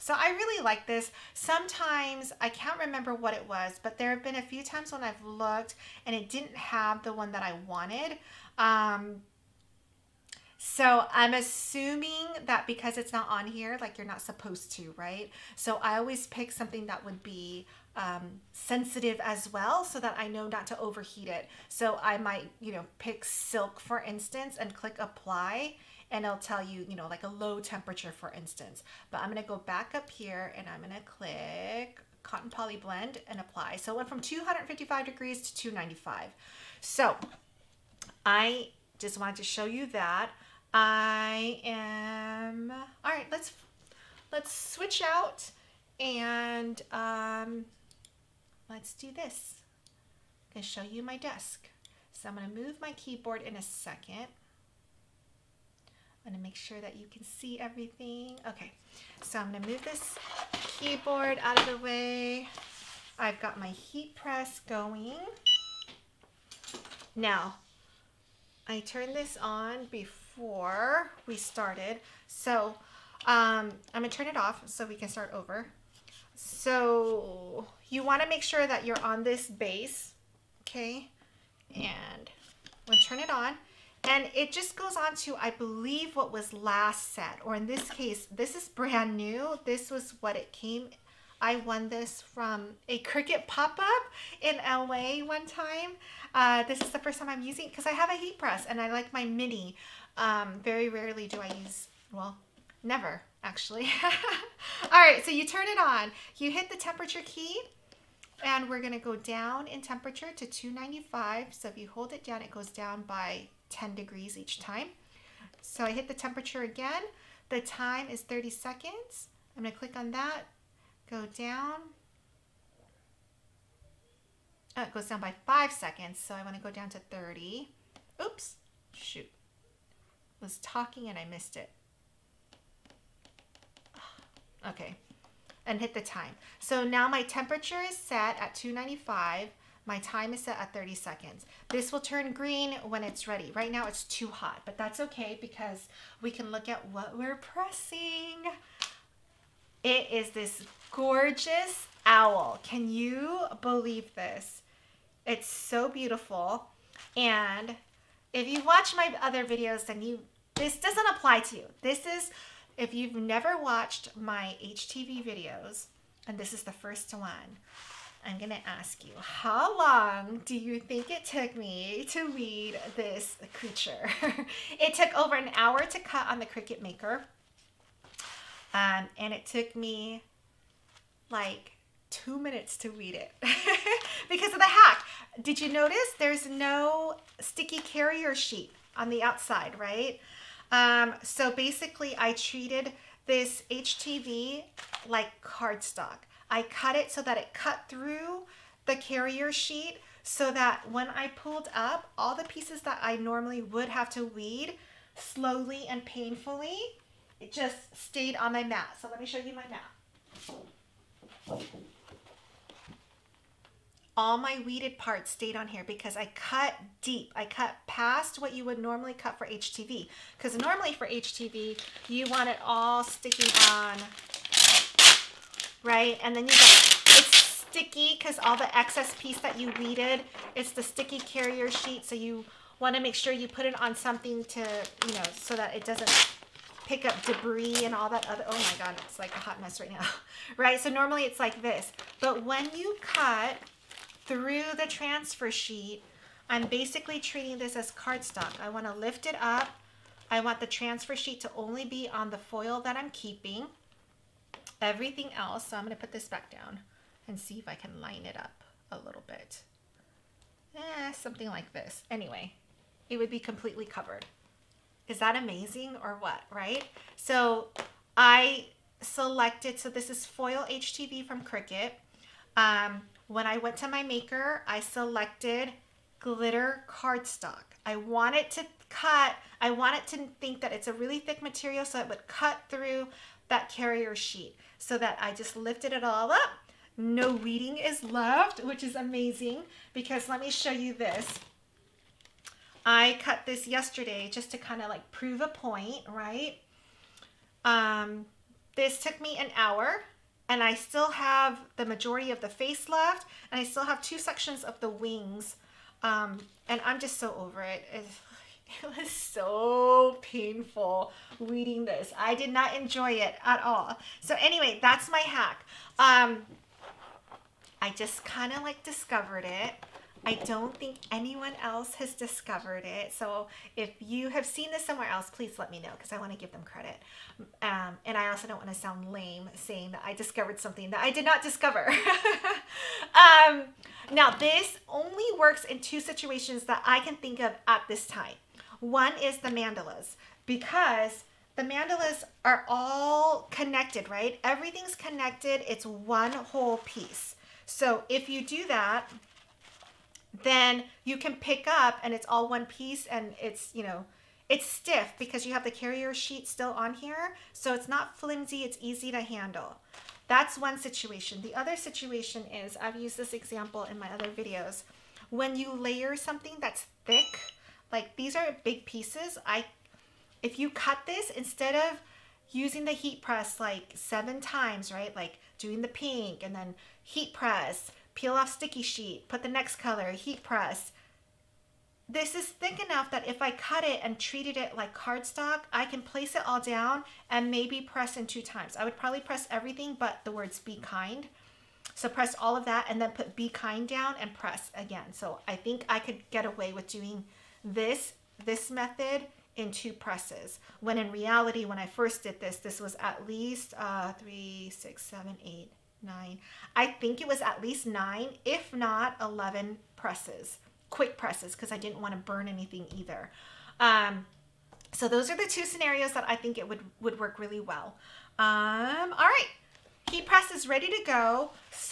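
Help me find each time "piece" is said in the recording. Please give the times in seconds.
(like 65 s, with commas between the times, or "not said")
202 s, 229 s, 346 s, 352 s, 368 s.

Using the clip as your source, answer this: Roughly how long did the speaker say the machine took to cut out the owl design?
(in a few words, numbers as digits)
Over an hour.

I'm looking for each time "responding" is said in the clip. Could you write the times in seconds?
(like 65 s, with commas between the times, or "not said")
not said.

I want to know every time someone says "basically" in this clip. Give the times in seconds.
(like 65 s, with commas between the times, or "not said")
191 s, 246 s.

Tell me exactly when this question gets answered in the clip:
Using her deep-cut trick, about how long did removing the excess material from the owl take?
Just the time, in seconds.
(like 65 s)
182 s.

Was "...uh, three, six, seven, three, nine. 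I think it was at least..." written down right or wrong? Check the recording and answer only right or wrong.
wrong.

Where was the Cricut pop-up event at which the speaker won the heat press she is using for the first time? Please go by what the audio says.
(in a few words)
LA.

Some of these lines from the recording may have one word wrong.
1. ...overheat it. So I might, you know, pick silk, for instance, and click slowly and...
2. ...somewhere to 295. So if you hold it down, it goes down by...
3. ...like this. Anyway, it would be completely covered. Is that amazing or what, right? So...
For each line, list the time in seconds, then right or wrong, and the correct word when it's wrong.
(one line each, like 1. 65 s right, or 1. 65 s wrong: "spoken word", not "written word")
1. 20 s wrong: "apply", not "slowly"
2. 109 s wrong: "temperature", not "somewhere"
3. 261 s right.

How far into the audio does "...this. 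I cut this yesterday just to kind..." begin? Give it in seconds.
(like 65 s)
290 s.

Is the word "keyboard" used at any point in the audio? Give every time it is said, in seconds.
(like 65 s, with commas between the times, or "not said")
52 s, 60 s.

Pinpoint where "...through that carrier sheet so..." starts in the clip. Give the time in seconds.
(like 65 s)
282 s.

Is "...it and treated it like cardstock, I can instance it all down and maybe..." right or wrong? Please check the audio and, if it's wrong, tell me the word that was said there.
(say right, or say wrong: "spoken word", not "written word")
wrong: "place", not "instance".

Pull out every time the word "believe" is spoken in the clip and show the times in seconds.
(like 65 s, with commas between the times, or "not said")
85 s, 153 s.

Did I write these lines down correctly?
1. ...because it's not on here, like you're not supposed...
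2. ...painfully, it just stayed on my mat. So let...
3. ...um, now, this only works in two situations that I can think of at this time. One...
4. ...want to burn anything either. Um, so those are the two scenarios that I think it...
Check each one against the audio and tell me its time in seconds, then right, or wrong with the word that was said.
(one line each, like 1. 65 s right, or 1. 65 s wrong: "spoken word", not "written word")
1. 12 s right
2. 206 s right
3. 333 s right
4. 411 s right.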